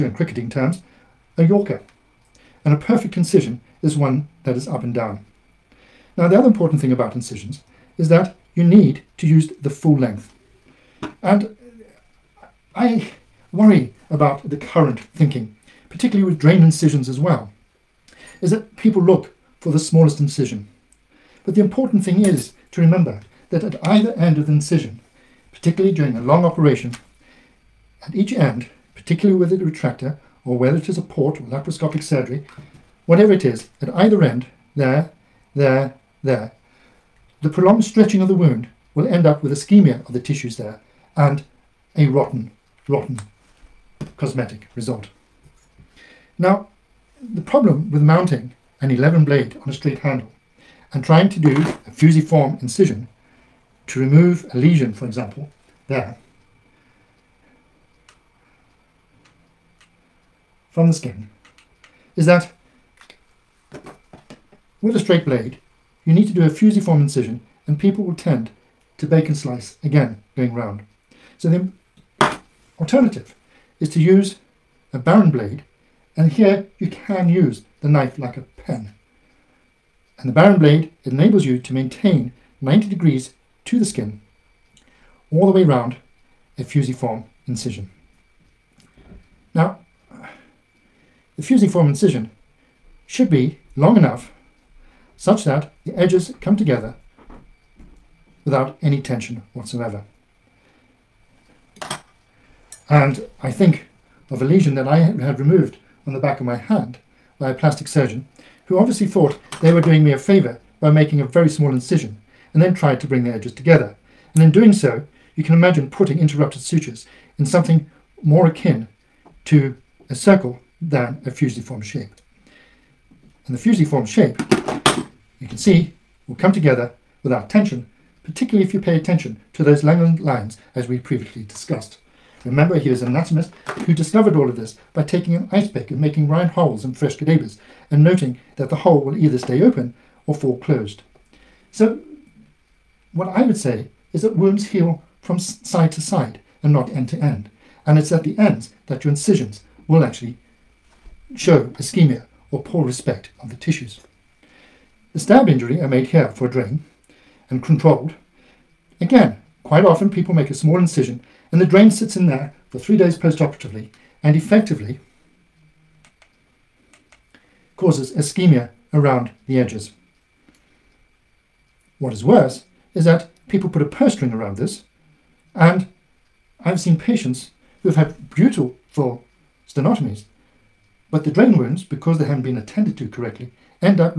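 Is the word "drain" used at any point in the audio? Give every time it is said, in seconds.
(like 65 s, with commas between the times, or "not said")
16 s, 156 s, 161 s, 181 s.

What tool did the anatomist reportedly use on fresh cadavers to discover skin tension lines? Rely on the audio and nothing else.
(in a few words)
An ice pick.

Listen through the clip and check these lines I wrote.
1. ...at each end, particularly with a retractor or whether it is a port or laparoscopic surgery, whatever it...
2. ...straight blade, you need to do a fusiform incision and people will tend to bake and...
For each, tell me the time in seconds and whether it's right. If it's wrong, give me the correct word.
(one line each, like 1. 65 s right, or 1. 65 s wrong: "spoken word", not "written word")
1. 28 s right
2. 64 s right.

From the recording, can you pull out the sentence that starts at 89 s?
Now, the fusiform incision should be long enough such that the edges come together without any tension whatsoever.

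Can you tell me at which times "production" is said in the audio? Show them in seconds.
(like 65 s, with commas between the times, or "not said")
not said.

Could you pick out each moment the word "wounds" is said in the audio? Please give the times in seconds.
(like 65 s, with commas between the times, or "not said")
38 s, 144 s, 181 s.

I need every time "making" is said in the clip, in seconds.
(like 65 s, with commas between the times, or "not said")
110 s, 135 s.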